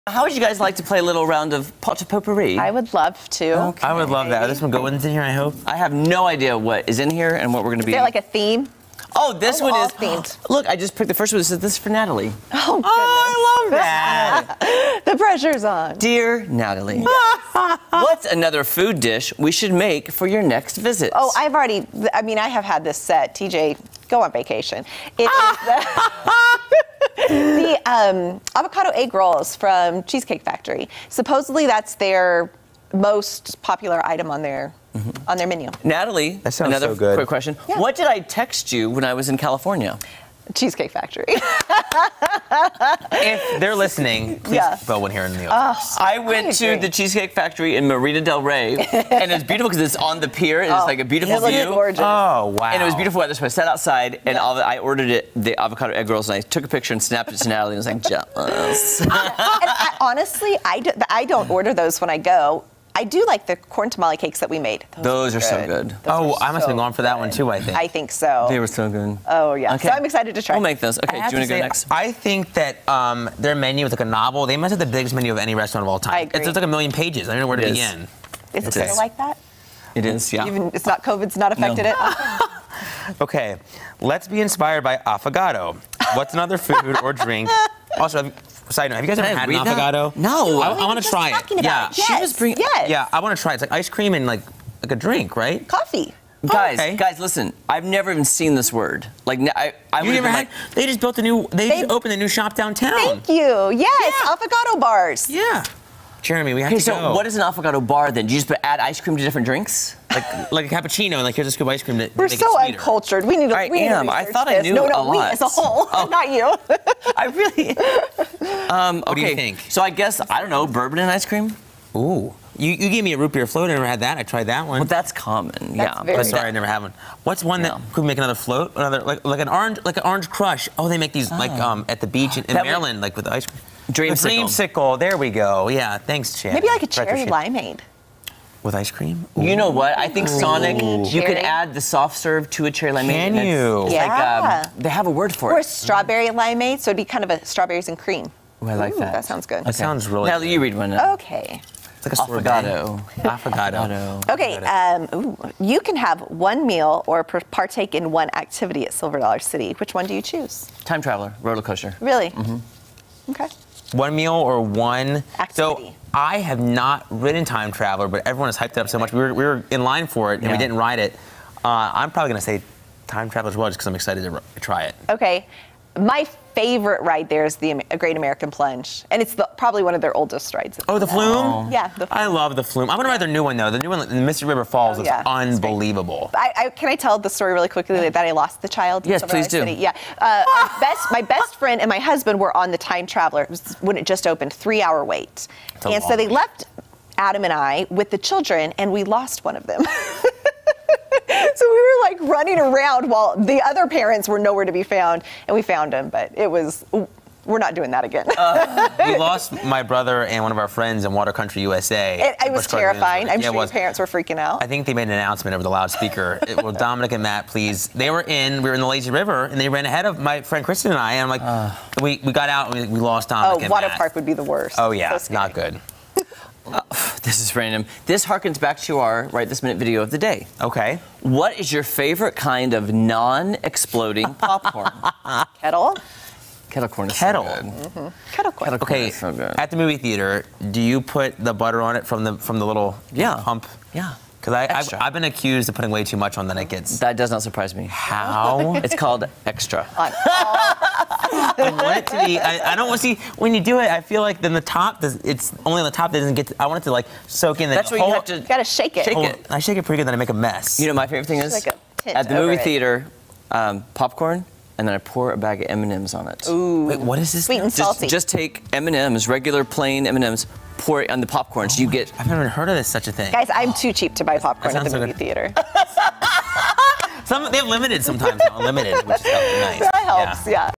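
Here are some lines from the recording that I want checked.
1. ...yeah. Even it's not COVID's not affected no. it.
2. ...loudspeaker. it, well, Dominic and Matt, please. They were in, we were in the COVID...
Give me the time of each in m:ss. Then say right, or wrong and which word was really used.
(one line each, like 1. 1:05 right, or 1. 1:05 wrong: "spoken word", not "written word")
1. 1:20 right
2. 3:35 wrong: "Lazy", not "COVID".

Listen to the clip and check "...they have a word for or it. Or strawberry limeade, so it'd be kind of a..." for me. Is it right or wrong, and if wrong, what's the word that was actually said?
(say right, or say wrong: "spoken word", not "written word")
right.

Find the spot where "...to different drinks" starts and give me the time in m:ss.
1:49.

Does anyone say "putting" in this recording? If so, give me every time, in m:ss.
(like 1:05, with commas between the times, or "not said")
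4:05.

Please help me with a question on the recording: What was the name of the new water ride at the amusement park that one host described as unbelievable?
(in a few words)
Mystic River Falls.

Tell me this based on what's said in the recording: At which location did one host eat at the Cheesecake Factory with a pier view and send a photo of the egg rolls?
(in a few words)
Marina Del Rey.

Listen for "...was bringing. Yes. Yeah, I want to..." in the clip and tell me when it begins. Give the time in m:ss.
1:32.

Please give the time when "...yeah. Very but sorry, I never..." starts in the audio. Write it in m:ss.
2:05.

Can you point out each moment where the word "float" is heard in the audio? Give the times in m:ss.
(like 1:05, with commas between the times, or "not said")
2:03, 2:08.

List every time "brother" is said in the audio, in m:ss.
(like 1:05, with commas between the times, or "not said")
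3:29.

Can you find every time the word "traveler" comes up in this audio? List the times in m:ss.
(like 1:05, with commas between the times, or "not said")
2:41, 2:47, 2:53, 3:13.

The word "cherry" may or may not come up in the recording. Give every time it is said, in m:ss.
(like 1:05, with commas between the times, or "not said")
2:16, 2:22.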